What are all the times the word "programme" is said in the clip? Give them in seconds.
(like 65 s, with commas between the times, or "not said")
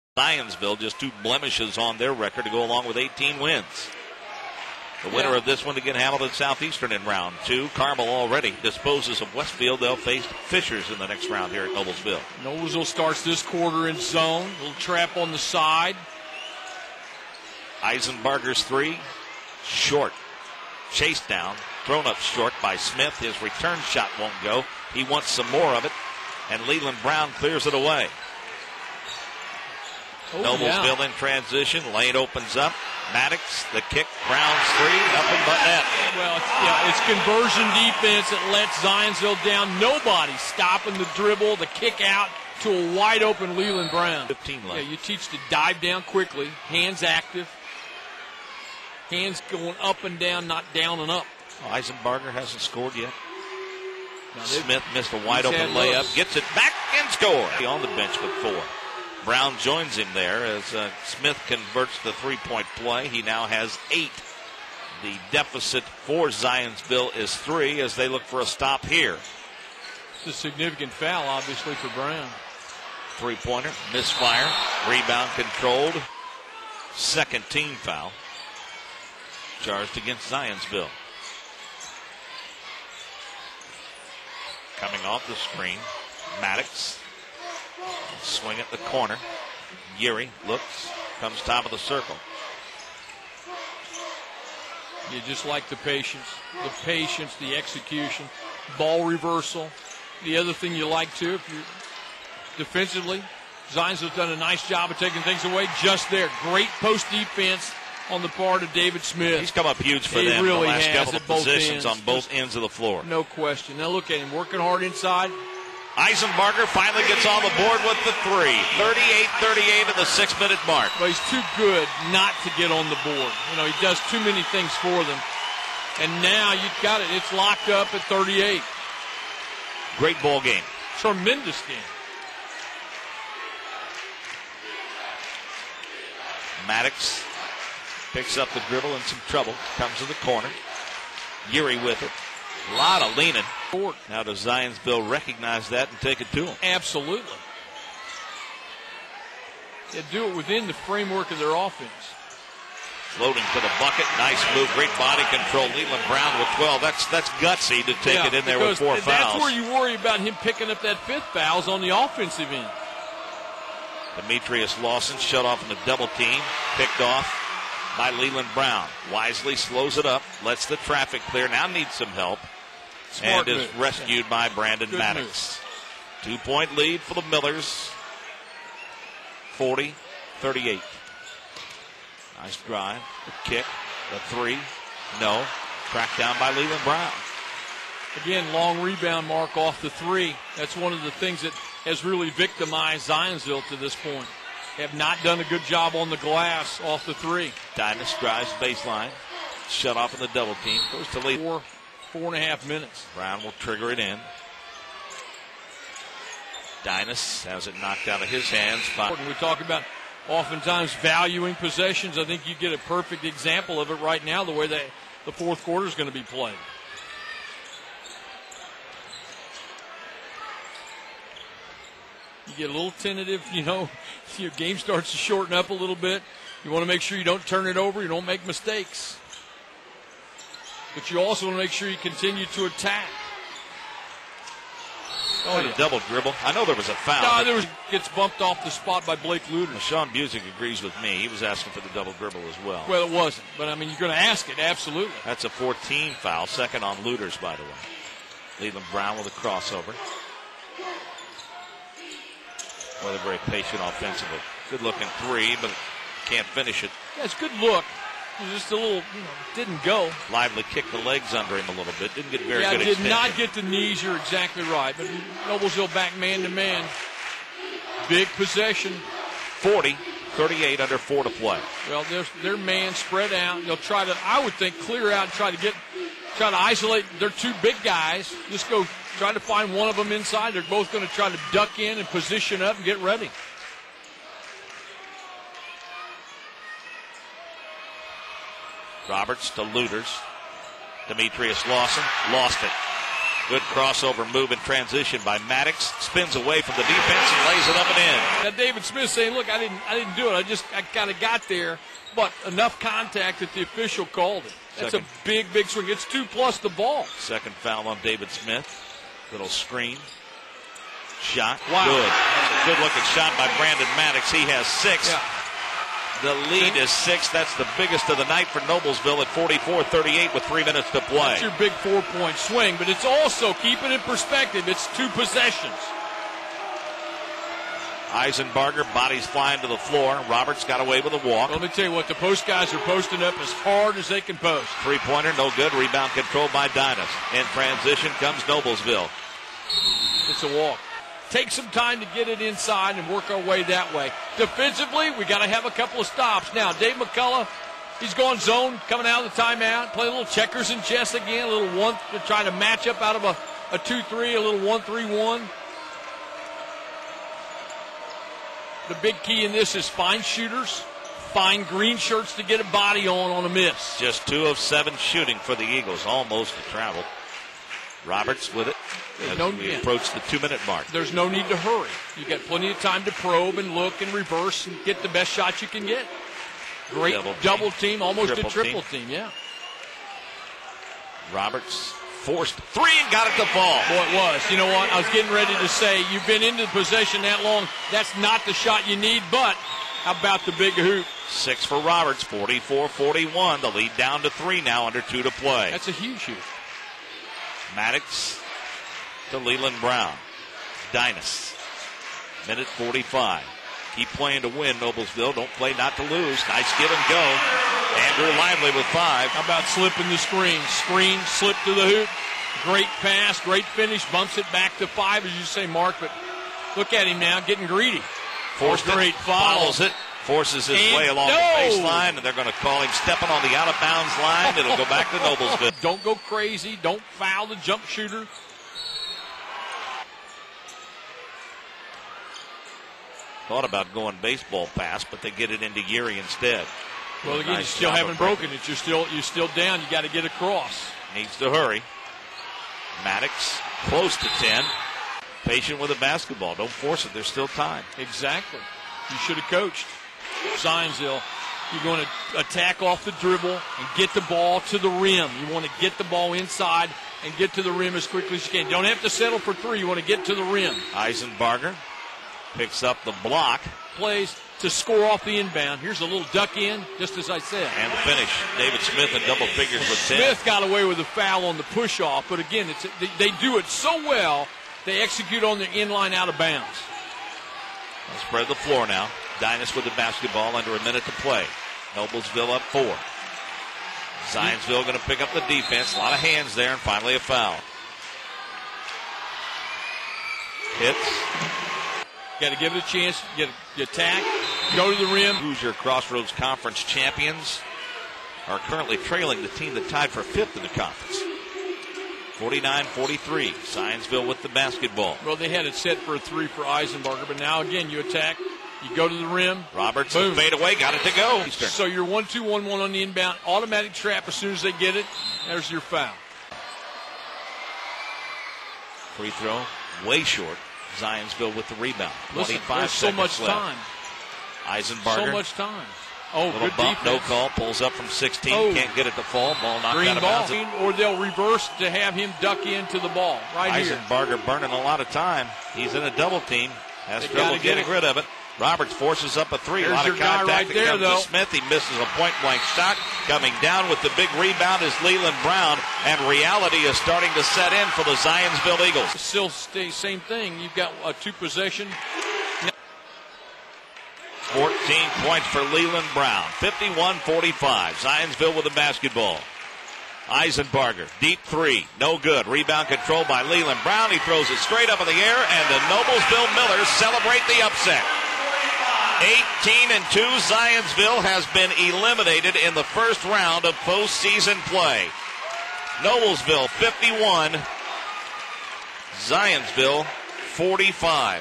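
not said.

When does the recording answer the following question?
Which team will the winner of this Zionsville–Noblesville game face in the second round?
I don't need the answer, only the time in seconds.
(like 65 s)
5 s.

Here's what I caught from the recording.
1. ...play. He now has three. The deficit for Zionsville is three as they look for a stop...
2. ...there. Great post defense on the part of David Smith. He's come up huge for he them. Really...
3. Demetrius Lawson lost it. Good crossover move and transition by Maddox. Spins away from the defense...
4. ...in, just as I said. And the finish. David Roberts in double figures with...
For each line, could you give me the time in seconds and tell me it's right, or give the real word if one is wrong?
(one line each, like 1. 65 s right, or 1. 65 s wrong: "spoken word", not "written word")
1. 62 s wrong: "eight", not "three"
2. 106 s right
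3. 291 s right
4. 466 s wrong: "Smith", not "Roberts".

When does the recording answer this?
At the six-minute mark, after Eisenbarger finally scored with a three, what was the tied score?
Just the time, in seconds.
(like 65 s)
118 s.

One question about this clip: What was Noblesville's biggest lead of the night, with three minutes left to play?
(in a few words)
44-38.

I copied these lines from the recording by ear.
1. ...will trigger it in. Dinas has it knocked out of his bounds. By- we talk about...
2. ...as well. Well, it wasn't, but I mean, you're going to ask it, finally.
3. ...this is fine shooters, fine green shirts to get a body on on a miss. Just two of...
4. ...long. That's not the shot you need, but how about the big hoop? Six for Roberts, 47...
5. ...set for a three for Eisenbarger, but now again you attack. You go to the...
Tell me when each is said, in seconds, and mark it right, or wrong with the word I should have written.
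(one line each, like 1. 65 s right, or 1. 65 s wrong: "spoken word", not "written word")
1. 203 s wrong: "hands", not "bounds"
2. 242 s wrong: "absolutely", not "finally"
3. 359 s right
4. 387 s wrong: "44", not "47"
5. 505 s right.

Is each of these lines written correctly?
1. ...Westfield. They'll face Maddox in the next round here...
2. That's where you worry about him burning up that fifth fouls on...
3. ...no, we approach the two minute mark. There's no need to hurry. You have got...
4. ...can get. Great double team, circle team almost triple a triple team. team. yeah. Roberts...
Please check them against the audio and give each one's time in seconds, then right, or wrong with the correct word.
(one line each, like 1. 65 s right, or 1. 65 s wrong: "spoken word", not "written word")
1. 9 s wrong: "Fishers", not "Maddox"
2. 159 s wrong: "picking", not "burning"
3. 369 s right
4. 375 s wrong: "double", not "circle".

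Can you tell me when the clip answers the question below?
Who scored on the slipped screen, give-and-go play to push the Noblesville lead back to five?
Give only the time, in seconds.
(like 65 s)
407 s.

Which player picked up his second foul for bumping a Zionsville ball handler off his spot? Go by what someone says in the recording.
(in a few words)
Blake Luder.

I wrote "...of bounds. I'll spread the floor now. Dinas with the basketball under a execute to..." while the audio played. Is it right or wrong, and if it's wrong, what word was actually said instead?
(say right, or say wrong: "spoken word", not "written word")
wrong: "minute", not "execute".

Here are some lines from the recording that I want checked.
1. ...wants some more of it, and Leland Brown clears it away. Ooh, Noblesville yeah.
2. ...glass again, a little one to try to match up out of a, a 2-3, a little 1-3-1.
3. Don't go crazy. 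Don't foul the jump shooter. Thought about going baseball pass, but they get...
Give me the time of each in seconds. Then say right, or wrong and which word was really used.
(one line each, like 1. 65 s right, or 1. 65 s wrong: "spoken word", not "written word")
1. 25 s right
2. 350 s wrong: "chess", not "glass"
3. 425 s right.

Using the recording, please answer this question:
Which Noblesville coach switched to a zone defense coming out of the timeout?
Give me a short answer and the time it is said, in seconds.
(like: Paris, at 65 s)
Dave McCullough, at 346 s.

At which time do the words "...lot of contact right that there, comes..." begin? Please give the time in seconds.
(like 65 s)
539 s.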